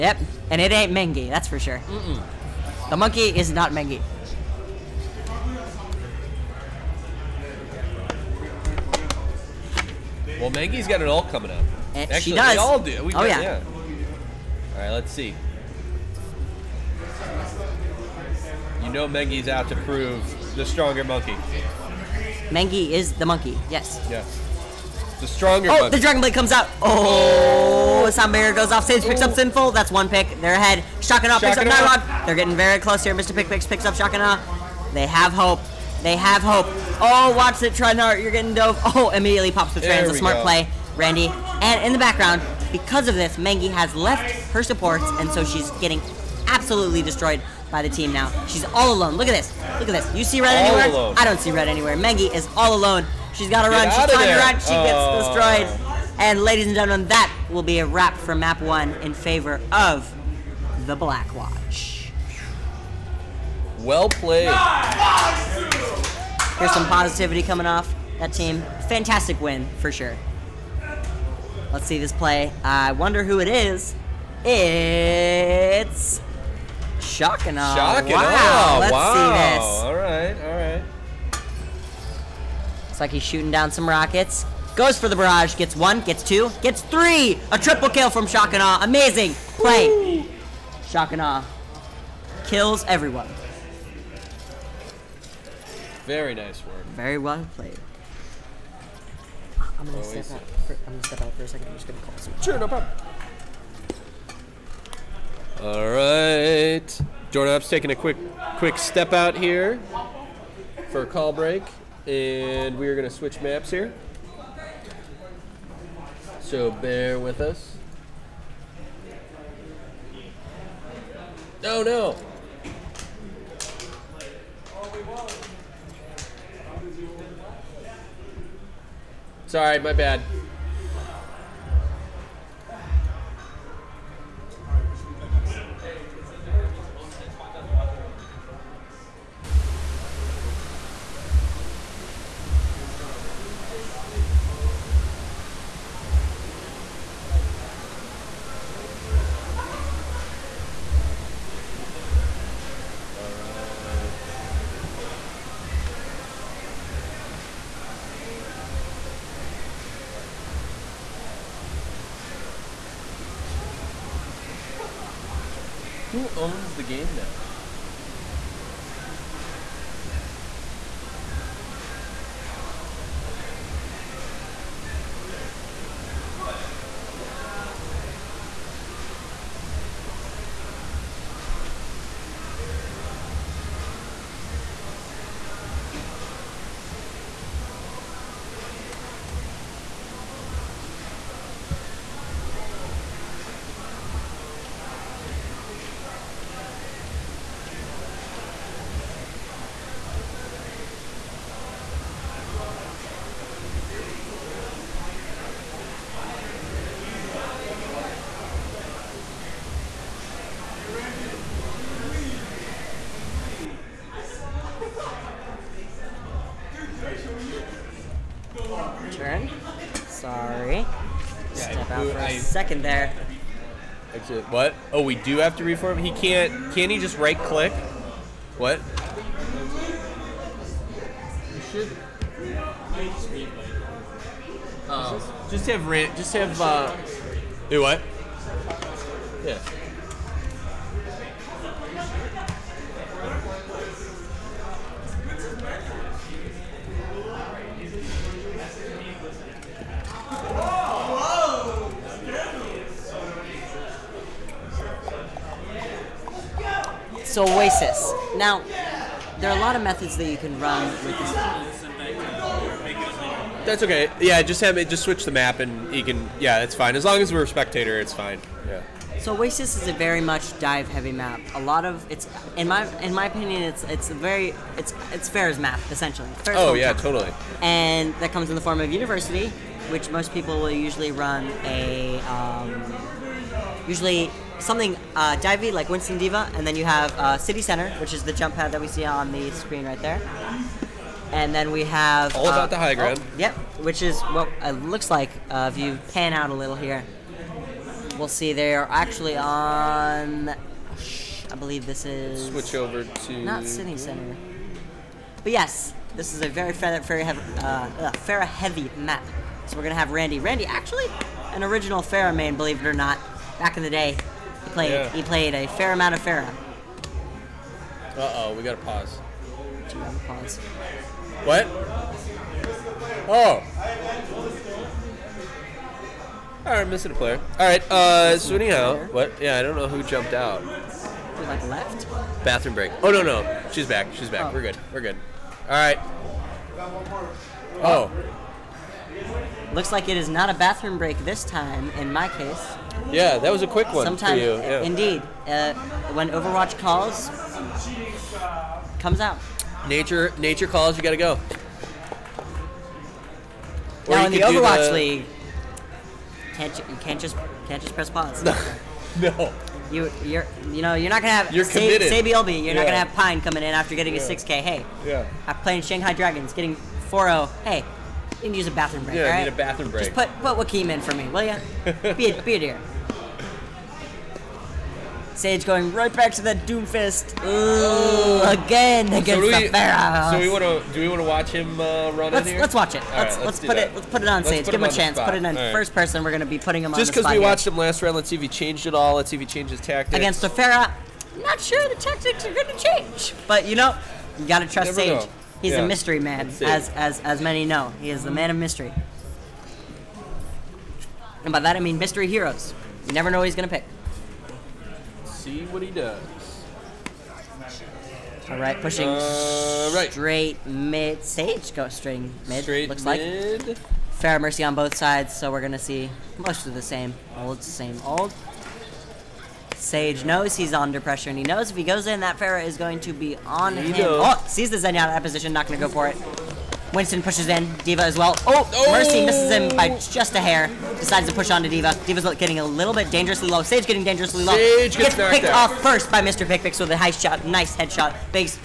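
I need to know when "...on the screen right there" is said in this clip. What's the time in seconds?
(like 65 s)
289 s.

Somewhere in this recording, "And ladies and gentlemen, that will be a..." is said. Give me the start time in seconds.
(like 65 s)
56 s.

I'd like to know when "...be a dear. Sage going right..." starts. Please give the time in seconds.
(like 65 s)
372 s.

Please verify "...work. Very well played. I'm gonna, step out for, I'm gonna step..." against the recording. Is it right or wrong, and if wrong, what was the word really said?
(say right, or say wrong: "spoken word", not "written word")
right.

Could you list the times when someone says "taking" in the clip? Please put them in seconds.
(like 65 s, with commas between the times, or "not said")
107 s.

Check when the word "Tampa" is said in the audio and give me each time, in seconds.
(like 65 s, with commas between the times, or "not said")
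not said.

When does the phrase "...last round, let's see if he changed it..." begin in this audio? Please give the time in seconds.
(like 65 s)
387 s.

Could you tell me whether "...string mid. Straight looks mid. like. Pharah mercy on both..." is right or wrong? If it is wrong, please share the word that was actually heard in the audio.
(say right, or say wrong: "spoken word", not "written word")
right.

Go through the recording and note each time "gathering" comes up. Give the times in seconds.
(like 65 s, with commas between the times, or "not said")
not said.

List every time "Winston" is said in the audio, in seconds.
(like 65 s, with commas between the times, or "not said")
285 s, 426 s.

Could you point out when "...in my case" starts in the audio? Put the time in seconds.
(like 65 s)
341 s.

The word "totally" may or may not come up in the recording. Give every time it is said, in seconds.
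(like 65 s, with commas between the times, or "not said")
277 s.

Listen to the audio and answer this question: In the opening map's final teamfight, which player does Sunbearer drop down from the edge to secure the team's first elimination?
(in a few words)
Sinful.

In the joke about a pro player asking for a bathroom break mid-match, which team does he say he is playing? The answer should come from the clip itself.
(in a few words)
Shanghai Dragons.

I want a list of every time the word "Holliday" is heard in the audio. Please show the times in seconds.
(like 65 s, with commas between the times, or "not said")
not said.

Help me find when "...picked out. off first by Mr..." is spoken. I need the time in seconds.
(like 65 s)
435 s.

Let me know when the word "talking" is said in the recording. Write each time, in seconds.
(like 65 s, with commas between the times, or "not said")
not said.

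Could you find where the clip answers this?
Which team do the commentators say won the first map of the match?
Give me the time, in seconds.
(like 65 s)
60 s.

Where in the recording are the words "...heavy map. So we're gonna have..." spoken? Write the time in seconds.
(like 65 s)
308 s.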